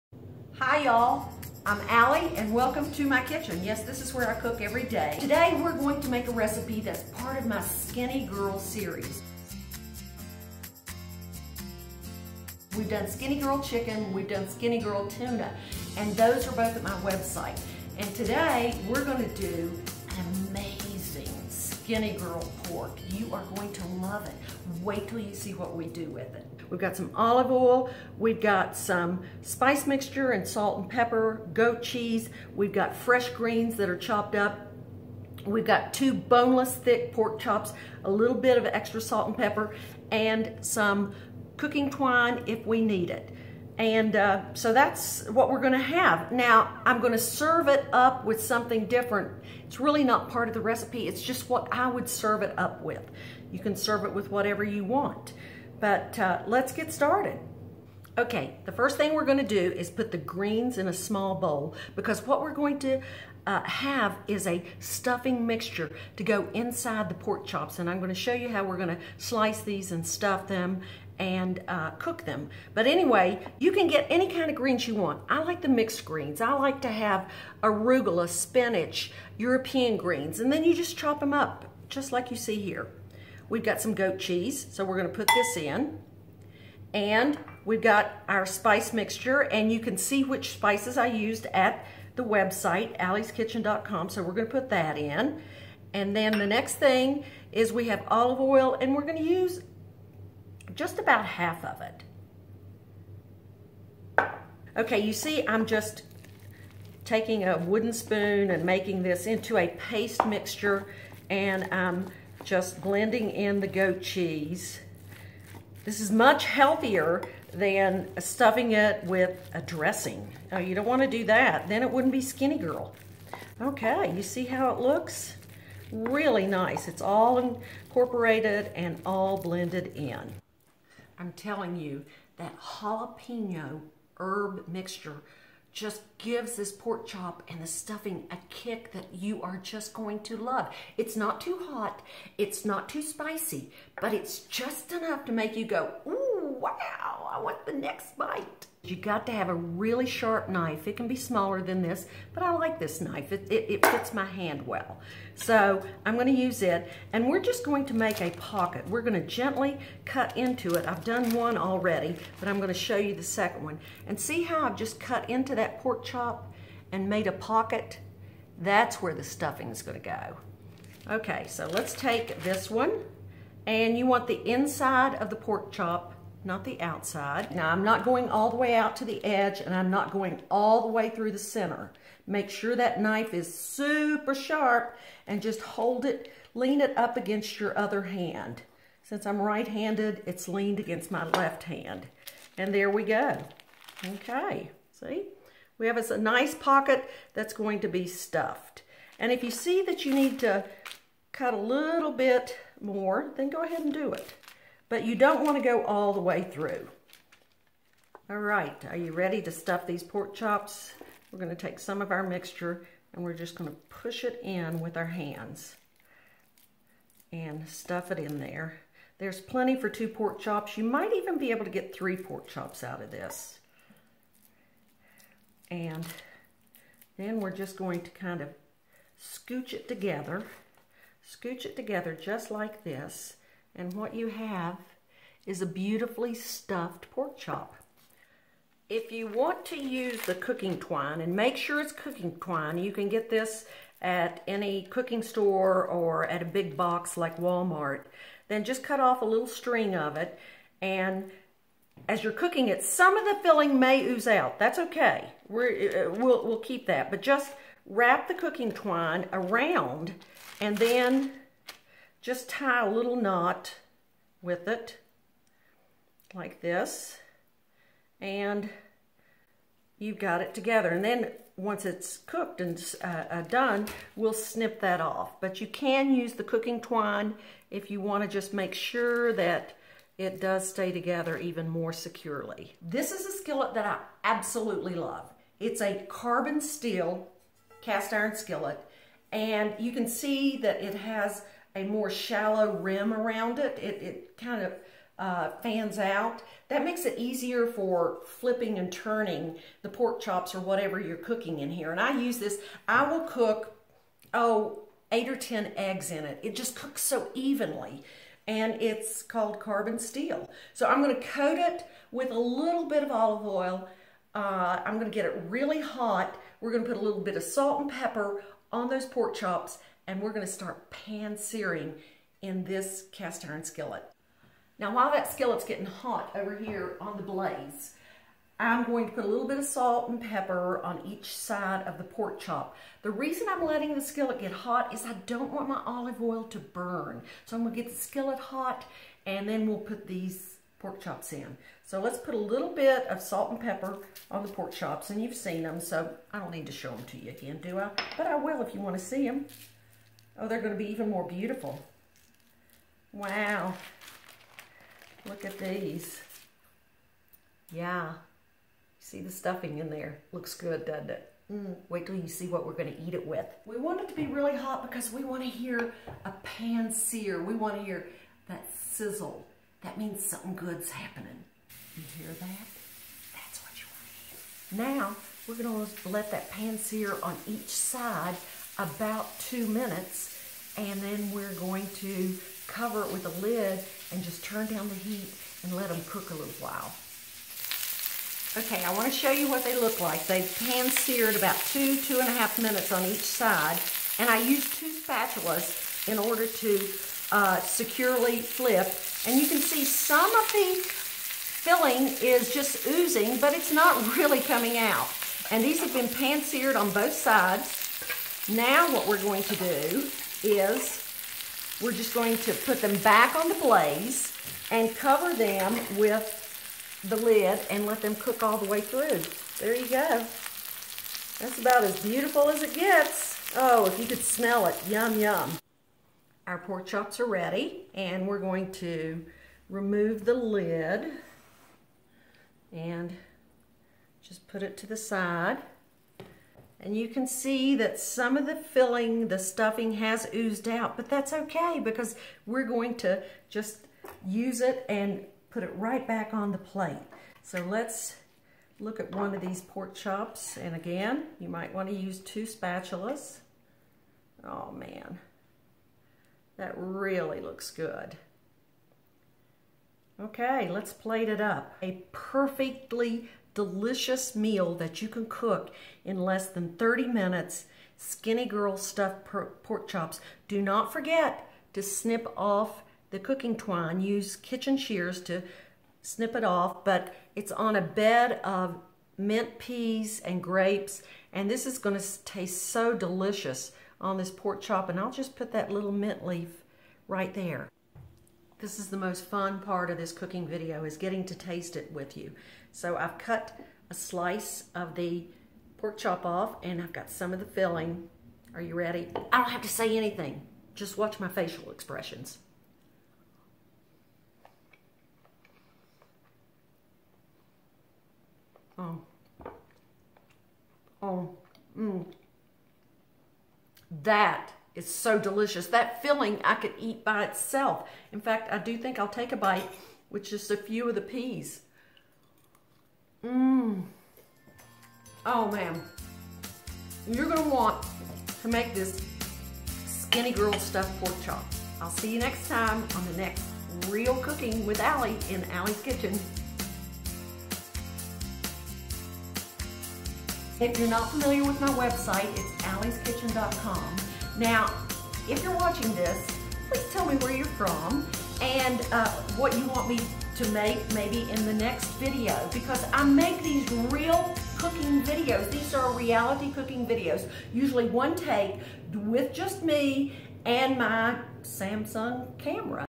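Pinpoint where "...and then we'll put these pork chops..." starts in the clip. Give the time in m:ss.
5:39.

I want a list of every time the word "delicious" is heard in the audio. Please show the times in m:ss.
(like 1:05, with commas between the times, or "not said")
7:43, 8:02, 8:35.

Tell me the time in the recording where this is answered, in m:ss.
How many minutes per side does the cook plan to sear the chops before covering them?
6:19.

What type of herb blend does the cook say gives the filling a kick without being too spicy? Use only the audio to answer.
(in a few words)
Jalapeno herb.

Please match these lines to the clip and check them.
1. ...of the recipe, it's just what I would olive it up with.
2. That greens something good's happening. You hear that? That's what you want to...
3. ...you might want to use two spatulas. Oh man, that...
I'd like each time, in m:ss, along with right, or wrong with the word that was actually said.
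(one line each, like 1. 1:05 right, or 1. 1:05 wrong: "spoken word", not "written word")
1. 0:50 wrong: "serve", not "olive"
2. 6:09 wrong: "means", not "greens"
3. 7:31 right.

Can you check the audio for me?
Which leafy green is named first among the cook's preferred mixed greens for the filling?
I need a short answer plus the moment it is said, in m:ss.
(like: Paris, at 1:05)
Arugula, at 1:17.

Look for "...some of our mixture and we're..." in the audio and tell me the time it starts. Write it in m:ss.
3:31.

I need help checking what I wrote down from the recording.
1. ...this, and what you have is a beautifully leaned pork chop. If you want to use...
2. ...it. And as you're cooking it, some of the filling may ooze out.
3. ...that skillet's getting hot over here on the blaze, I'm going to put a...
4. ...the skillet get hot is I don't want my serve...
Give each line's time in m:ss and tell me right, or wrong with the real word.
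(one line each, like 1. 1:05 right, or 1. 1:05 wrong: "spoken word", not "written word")
1. 3:52 wrong: "stuffed", not "leaned"
2. 4:10 right
3. 5:25 right
4. 5:33 wrong: "olive", not "serve".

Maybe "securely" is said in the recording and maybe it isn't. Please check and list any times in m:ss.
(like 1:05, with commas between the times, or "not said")
4:41, 6:37.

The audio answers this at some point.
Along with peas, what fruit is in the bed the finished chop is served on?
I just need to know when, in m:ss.
8:00.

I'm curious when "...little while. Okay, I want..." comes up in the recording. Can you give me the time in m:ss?
6:26.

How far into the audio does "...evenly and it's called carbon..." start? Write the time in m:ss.
5:07.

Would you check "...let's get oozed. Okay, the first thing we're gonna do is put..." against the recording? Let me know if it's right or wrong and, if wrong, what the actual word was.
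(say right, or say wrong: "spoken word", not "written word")
wrong: "started", not "oozed".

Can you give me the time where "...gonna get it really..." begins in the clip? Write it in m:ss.
5:14.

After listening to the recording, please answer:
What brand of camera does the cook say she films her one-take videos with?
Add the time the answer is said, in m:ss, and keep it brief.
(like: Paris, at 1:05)
Samsung, at 9:21.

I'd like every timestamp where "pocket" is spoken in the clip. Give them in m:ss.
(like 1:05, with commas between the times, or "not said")
2:38, 2:47, 3:16.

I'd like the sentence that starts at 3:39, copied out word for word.
There's plenty for two pork chops.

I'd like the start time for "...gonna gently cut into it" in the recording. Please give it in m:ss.
2:39.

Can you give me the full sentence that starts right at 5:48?
But I will if you wanna see them.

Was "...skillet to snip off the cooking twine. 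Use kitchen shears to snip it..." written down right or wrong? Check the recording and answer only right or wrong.
wrong.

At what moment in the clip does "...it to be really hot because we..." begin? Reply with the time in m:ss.
6:04.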